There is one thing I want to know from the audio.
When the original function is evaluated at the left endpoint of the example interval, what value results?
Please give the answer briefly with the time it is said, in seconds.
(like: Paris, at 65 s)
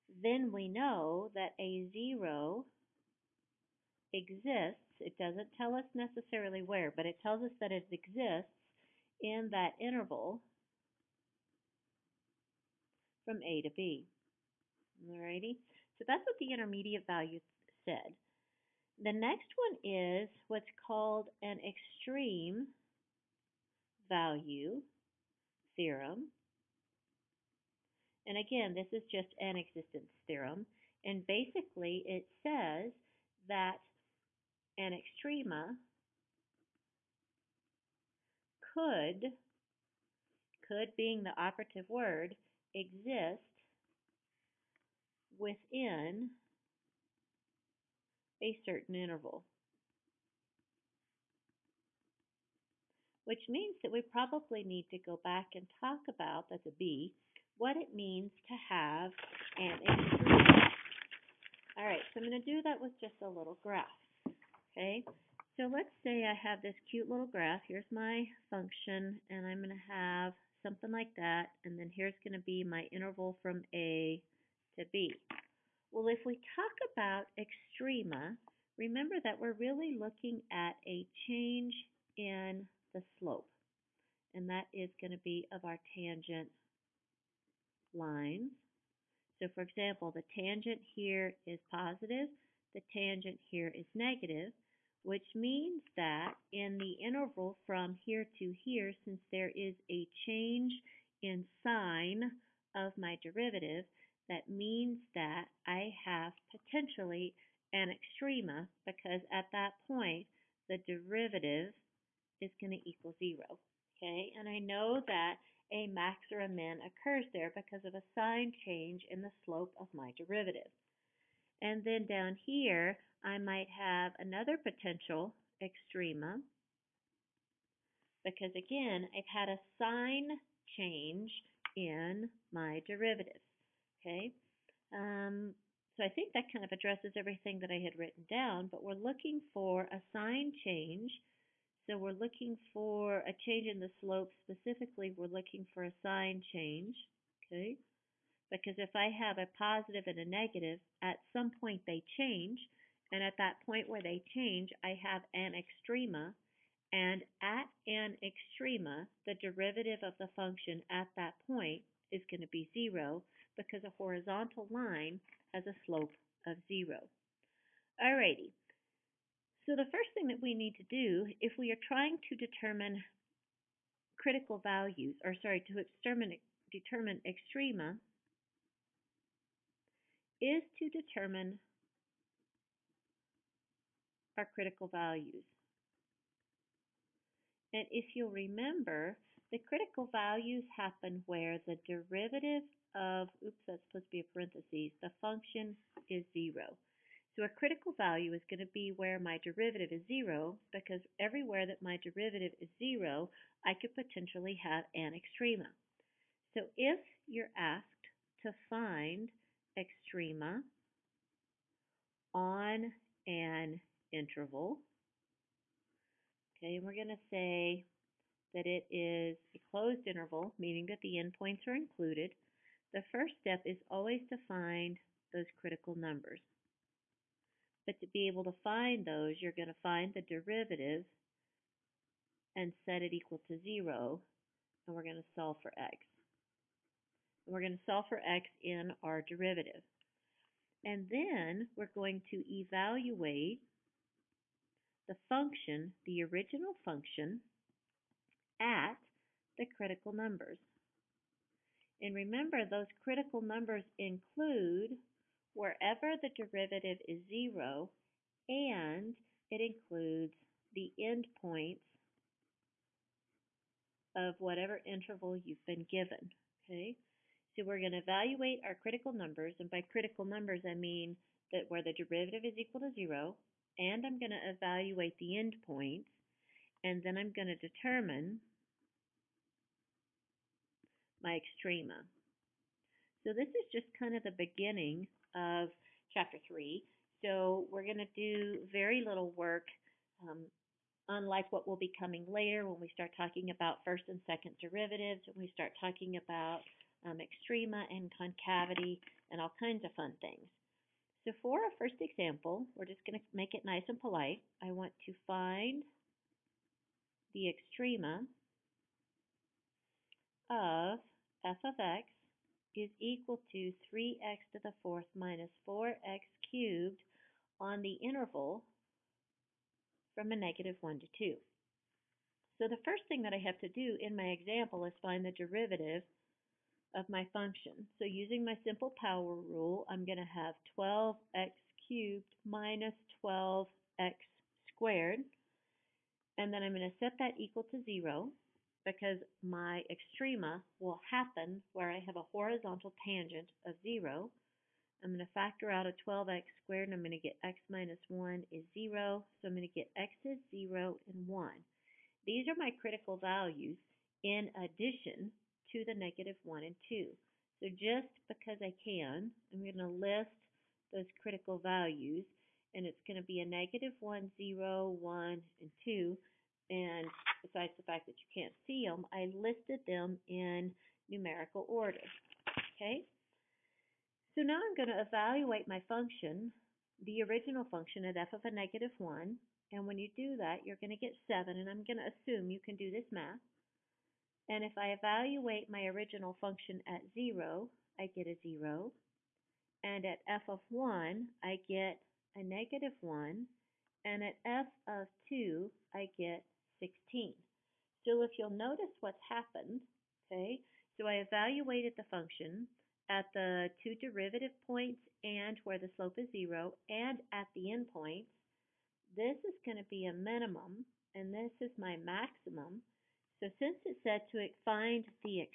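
7, at 381 s.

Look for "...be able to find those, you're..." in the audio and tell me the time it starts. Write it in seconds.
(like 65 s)
228 s.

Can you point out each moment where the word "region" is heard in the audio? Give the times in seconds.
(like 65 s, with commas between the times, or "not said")
not said.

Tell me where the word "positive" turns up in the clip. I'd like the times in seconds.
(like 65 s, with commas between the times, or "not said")
91 s, 149 s.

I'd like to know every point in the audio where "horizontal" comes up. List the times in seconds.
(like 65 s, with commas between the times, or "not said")
163 s, 342 s.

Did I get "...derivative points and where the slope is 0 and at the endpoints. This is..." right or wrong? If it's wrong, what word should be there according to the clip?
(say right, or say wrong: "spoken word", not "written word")
right.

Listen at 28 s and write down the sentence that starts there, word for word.
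And again, this is just an existence theorem.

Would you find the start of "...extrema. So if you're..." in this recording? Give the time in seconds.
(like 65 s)
205 s.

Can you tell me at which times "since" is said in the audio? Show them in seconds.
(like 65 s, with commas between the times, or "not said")
99 s, 413 s.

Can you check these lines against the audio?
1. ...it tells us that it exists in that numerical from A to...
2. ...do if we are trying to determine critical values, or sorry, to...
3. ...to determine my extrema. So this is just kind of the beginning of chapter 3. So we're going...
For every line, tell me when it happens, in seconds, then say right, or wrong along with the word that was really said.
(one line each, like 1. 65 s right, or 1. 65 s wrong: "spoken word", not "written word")
1. 7 s wrong: "interval", not "numerical"
2. 170 s right
3. 277 s right.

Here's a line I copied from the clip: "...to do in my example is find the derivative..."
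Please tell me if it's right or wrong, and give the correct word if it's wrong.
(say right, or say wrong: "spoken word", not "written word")
right.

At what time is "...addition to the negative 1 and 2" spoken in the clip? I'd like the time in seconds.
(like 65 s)
354 s.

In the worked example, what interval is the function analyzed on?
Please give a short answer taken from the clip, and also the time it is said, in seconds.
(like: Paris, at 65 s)
-1 to 2, at 320 s.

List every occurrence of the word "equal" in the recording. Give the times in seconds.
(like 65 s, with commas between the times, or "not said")
112 s, 233 s, 272 s, 313 s, 337 s.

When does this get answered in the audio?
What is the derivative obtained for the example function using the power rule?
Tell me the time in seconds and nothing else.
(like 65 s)
330 s.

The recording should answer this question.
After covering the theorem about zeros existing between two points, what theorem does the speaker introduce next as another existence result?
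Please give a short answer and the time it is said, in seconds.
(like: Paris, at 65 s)
Extreme value theorem, at 21 s.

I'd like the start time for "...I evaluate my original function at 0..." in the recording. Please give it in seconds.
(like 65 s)
384 s.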